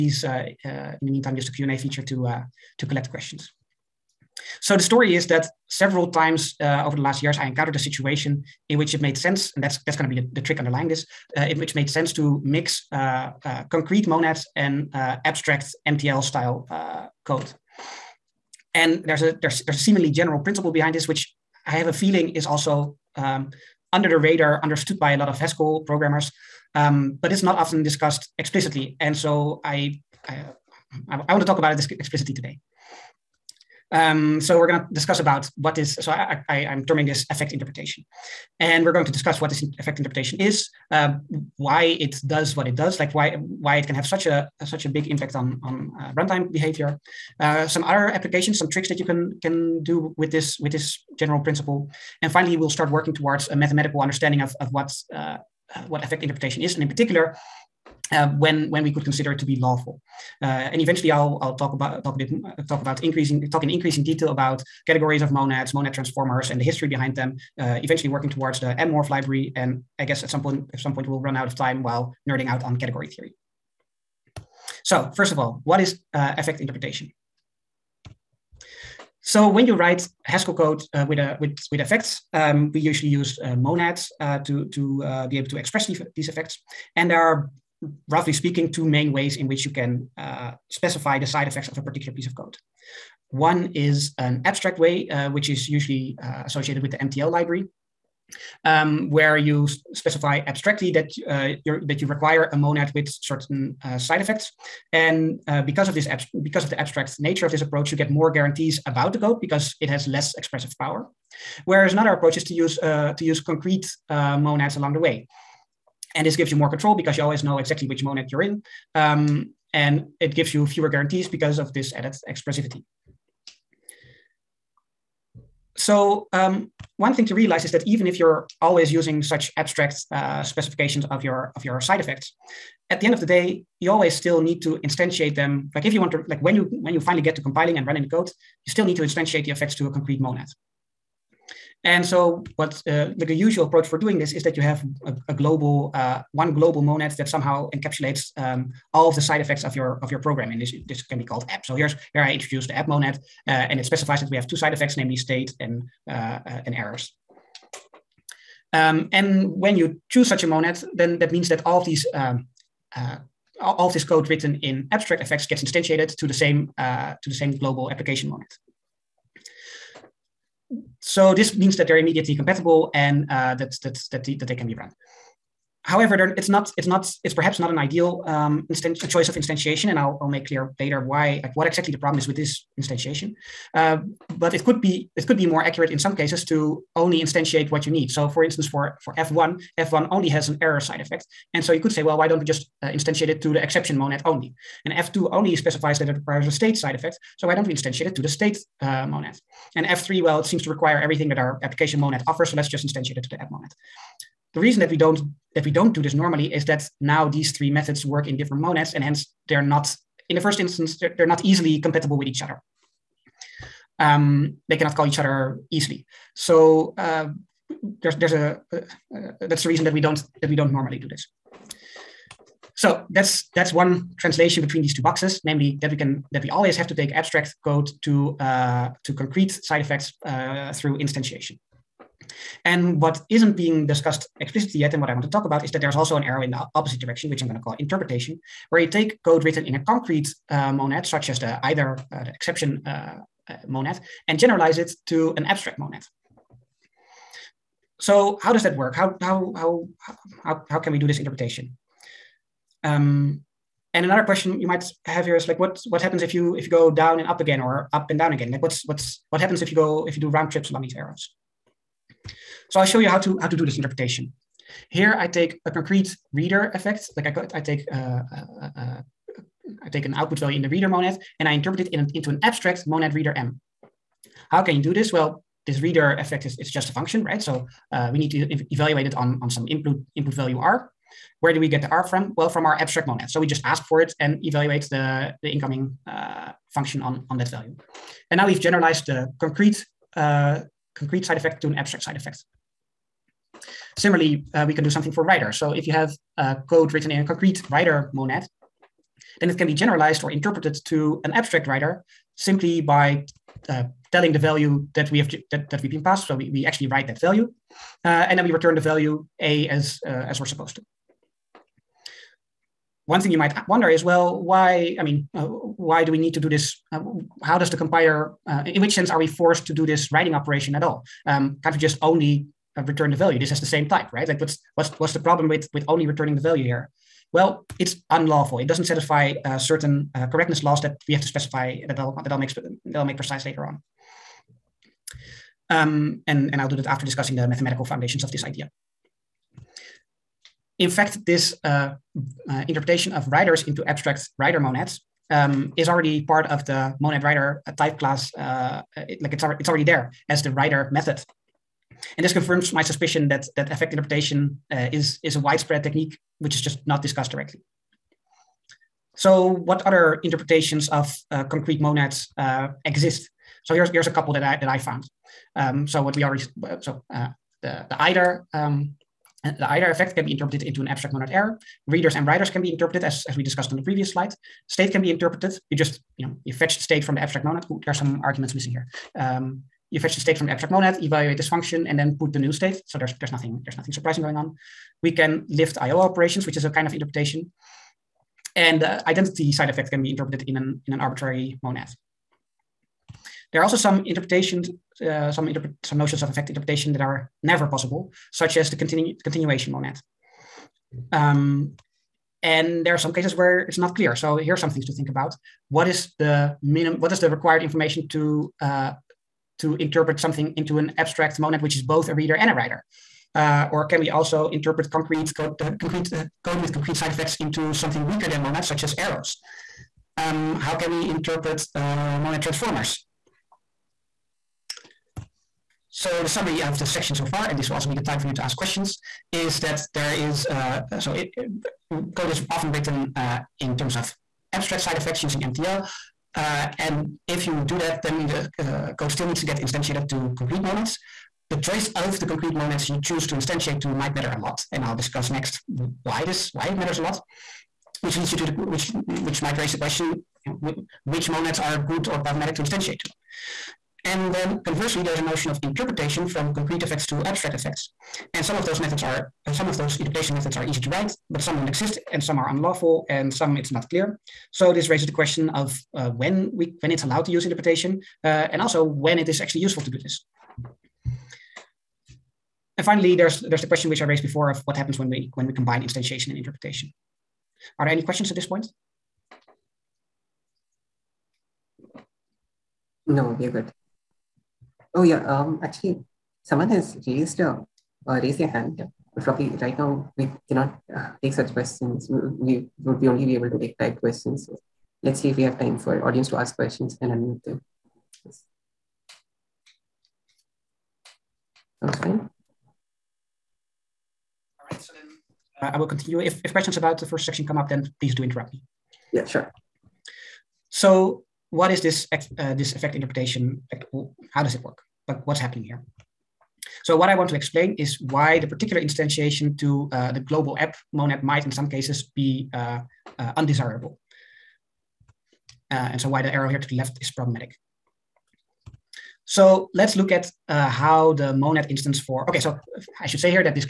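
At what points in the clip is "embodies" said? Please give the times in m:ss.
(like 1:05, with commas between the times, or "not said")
not said.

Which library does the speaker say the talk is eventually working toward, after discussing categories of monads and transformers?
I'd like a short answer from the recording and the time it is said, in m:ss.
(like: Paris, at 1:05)
mmorph, at 1:08.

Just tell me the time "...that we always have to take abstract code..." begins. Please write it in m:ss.
3:46.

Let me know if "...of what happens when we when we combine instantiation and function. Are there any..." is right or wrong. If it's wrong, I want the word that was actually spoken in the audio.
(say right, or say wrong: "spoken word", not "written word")
wrong: "interpretation", not "function".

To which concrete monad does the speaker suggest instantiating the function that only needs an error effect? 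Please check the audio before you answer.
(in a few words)
The exception monad.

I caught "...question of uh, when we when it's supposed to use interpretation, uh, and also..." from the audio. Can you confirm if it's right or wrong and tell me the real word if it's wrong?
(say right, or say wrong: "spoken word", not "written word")
wrong: "allowed", not "supposed".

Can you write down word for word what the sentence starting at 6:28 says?
And the identity side effect can be interpreted in an, in an arbitrary monad.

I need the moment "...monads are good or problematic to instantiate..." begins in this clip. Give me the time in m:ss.
7:31.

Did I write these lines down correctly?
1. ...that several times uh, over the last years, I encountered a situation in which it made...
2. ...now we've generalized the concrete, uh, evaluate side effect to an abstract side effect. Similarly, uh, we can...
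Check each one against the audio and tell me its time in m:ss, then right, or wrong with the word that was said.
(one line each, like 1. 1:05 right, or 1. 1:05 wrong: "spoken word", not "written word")
1. 0:05 right
2. 4:48 wrong: "concrete", not "evaluate".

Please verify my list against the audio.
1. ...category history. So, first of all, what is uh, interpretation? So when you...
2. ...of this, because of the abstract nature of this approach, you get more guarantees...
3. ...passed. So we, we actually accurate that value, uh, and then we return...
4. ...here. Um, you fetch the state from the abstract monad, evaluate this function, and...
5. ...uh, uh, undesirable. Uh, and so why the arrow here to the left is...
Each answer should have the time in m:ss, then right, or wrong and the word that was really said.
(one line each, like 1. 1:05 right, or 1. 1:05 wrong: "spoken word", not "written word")
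1. 1:12 wrong: "theory", not "history"
2. 1:45 right
3. 5:06 wrong: "write", not "accurate"
4. 6:18 right
5. 8:42 right.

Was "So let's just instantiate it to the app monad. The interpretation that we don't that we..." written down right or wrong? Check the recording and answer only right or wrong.
wrong.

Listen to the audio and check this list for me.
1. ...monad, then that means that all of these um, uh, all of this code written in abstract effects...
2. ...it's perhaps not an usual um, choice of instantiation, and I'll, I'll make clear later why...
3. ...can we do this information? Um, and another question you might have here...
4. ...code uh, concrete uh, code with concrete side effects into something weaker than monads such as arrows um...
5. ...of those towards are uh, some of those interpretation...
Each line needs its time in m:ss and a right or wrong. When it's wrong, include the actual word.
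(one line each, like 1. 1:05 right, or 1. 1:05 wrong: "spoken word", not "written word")
1. 2:40 right
2. 2:57 wrong: "ideal", not "usual"
3. 4:10 wrong: "interpretation", not "information"
4. 6:55 right
5. 7:38 wrong: "methods", not "towards".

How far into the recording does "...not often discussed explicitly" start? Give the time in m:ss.
0:27.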